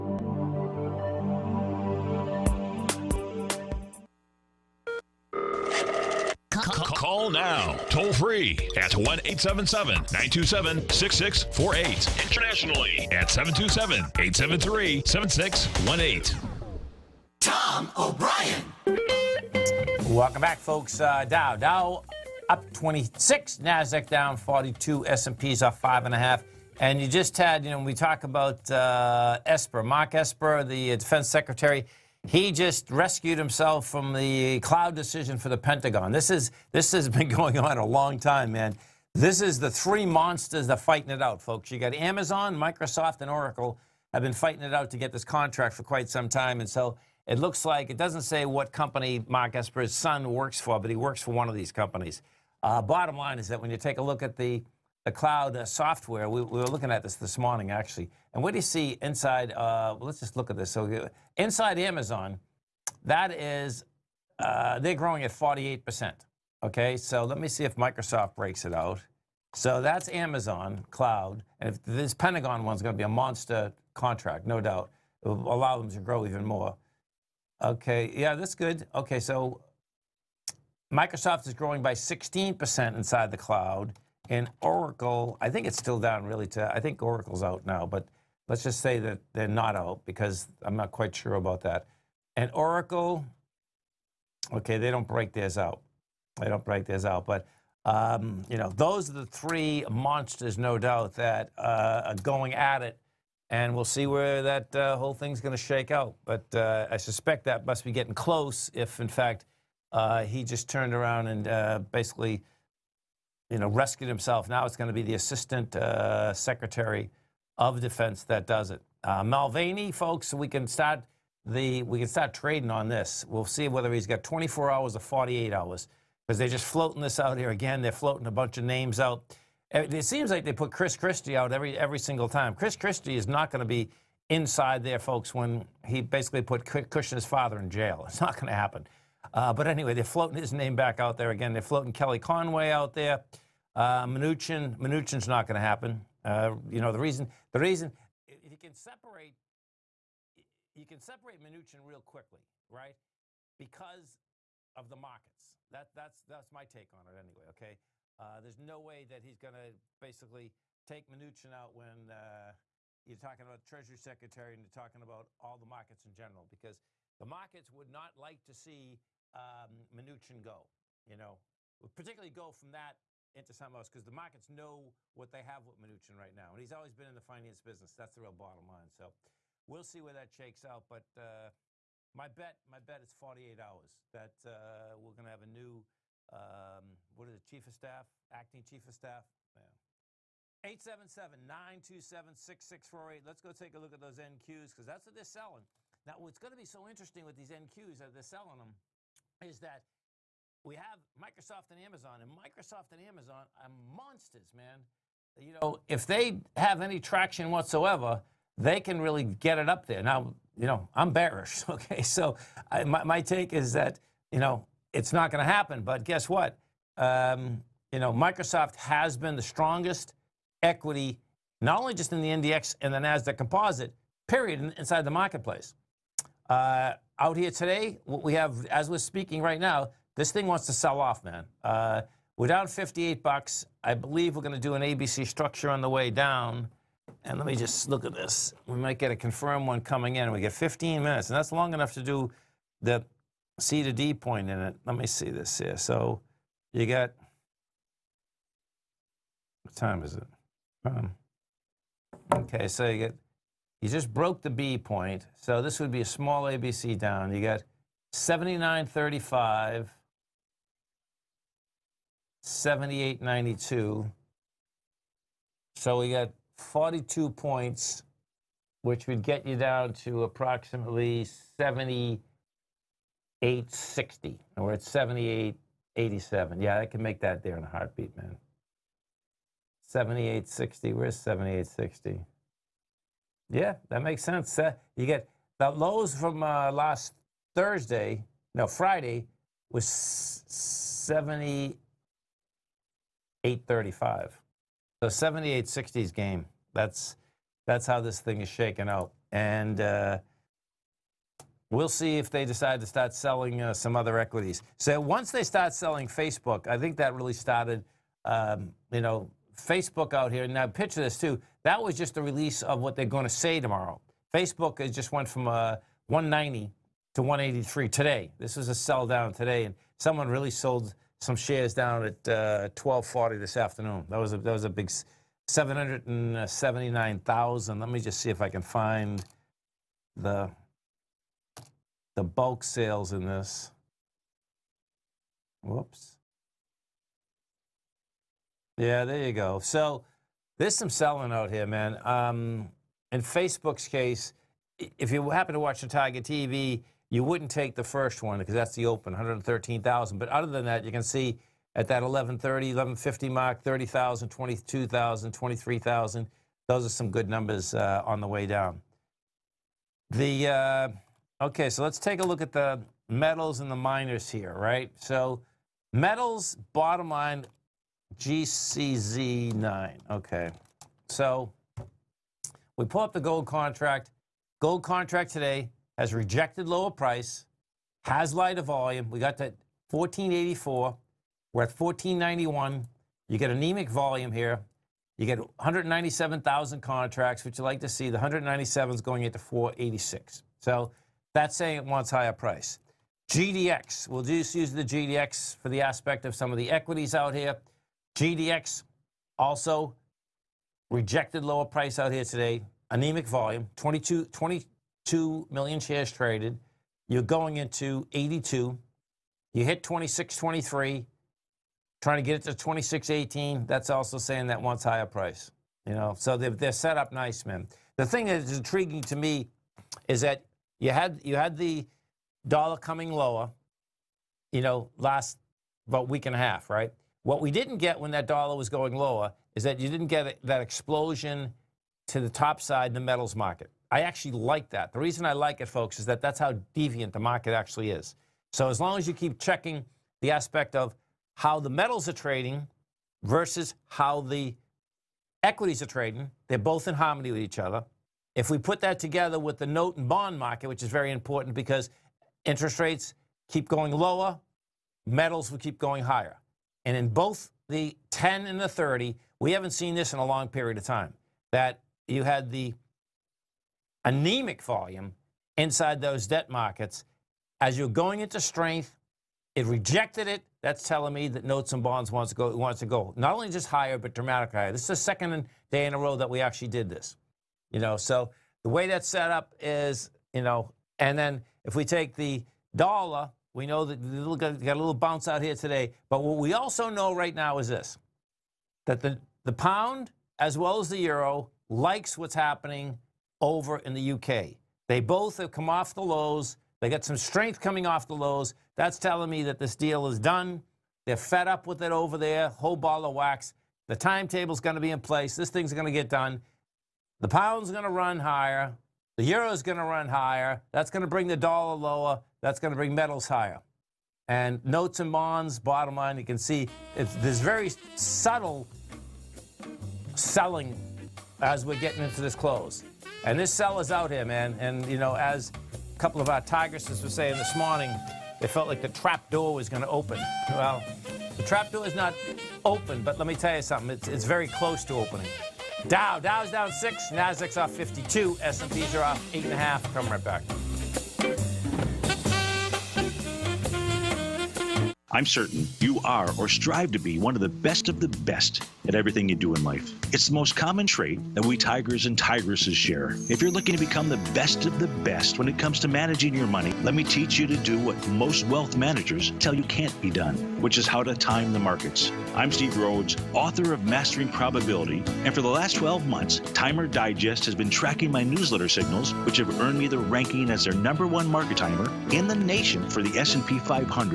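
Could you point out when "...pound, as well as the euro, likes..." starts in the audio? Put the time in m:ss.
8:09.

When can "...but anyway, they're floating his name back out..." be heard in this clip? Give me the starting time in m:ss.
2:19.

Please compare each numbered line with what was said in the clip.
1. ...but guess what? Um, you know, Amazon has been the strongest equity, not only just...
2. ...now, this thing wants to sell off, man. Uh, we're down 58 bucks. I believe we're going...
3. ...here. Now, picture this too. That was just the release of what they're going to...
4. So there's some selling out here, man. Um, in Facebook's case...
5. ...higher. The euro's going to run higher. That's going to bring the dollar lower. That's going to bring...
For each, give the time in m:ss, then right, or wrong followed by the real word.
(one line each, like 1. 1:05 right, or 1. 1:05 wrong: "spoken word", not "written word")
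1. 3:35 wrong: "Microsoft", not "Amazon"
2. 3:49 right
3. 5:10 right
4. 5:39 right
5. 8:28 right.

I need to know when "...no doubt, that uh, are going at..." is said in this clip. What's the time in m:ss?
1:40.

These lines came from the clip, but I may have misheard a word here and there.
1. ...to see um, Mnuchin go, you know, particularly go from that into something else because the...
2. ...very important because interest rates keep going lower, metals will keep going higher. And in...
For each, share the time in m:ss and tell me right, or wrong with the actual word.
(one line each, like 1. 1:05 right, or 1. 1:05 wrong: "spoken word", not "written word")
1. 2:48 right
2. 7:30 right.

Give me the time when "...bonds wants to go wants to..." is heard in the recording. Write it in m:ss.
7:51.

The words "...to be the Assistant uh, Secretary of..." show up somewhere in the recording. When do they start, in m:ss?
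1:54.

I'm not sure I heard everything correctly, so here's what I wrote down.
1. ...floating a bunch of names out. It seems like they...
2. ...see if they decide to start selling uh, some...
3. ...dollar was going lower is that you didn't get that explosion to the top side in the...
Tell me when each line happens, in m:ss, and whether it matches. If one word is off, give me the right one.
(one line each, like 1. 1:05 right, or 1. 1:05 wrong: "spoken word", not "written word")
1. 2:07 right
2. 5:01 right
3. 7:08 right.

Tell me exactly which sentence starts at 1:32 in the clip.
And Oracle, okay, they don't break theirs out.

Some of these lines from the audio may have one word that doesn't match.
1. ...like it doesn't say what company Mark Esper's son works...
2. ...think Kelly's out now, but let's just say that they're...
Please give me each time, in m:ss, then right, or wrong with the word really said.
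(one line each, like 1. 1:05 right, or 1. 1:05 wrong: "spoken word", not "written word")
1. 0:47 right
2. 1:26 wrong: "Oracle", not "Kelly".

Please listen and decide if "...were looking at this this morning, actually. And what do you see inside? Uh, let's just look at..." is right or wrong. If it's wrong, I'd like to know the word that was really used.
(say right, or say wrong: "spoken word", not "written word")
right.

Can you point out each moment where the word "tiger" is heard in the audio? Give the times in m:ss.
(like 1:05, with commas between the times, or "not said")
5:45, 9:11.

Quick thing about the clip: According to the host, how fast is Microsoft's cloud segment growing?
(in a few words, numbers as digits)
16%.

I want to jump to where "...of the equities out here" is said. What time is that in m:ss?
6:36.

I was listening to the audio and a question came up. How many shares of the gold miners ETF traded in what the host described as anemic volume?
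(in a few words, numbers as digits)
22 million.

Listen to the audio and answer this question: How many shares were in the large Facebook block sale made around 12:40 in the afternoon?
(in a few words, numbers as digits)
779,000.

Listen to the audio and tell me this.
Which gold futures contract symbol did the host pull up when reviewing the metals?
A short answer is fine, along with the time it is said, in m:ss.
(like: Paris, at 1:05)
GCZ9, at 6:08.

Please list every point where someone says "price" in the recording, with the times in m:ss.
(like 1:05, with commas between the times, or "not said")
6:16, 6:32, 6:41, 6:55.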